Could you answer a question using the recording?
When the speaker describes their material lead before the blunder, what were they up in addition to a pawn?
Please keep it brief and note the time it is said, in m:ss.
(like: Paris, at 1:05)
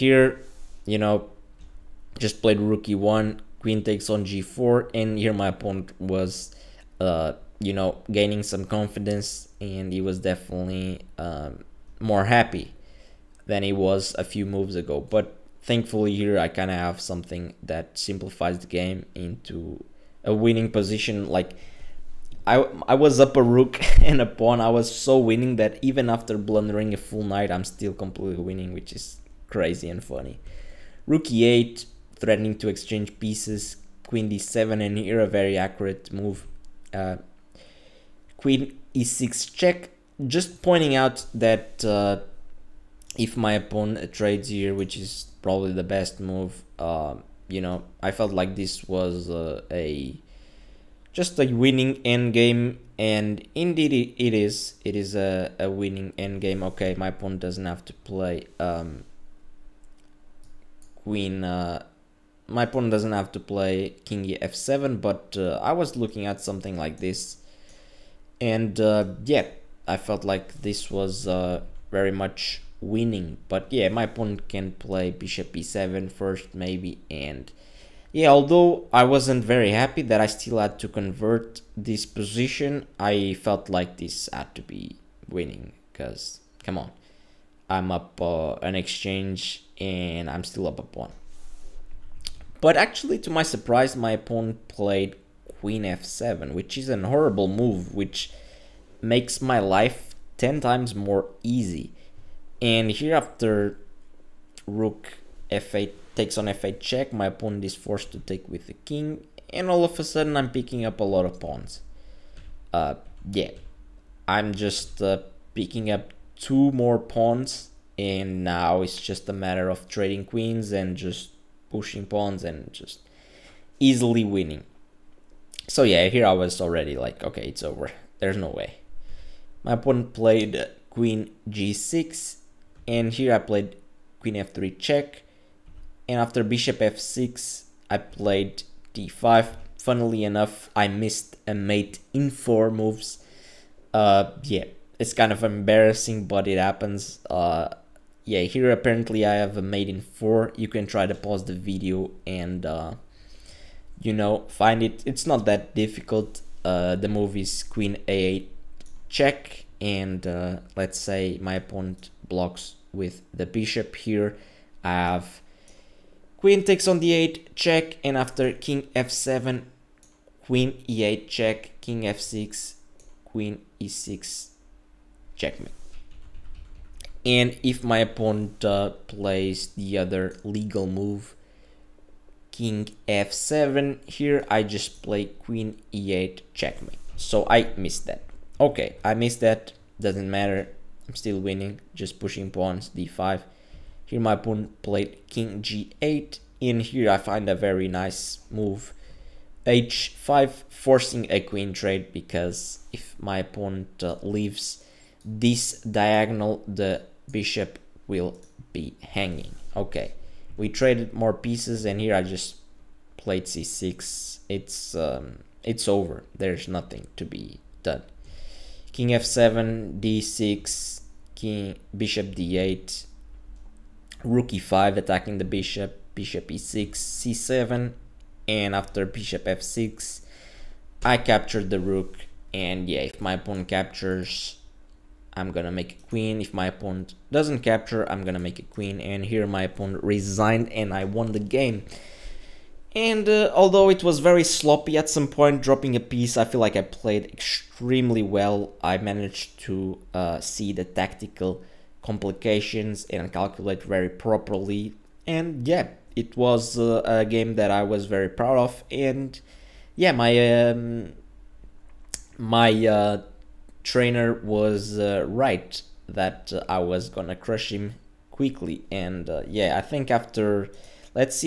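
A rook, at 0:23.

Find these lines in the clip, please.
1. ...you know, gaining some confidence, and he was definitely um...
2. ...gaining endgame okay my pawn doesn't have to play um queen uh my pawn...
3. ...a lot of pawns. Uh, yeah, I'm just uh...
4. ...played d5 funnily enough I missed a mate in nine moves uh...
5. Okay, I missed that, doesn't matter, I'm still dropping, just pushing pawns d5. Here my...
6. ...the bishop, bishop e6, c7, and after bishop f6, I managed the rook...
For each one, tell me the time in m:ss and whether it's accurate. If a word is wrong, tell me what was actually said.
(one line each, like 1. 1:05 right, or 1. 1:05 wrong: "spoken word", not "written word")
1. 0:07 right
2. 0:55 wrong: "winning", not "gaining"
3. 1:50 right
4. 2:17 wrong: "four", not "nine"
5. 3:08 wrong: "winning", not "dropping"
6. 3:45 wrong: "captured", not "managed".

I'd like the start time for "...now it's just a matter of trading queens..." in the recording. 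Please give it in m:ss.
1:58.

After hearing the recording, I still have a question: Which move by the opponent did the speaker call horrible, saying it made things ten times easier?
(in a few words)
Queen f7.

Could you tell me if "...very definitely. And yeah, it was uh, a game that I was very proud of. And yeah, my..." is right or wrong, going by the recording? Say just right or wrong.
wrong.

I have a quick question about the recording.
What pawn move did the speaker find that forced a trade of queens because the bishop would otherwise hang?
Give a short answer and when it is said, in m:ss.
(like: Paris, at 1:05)
h5, at 3:19.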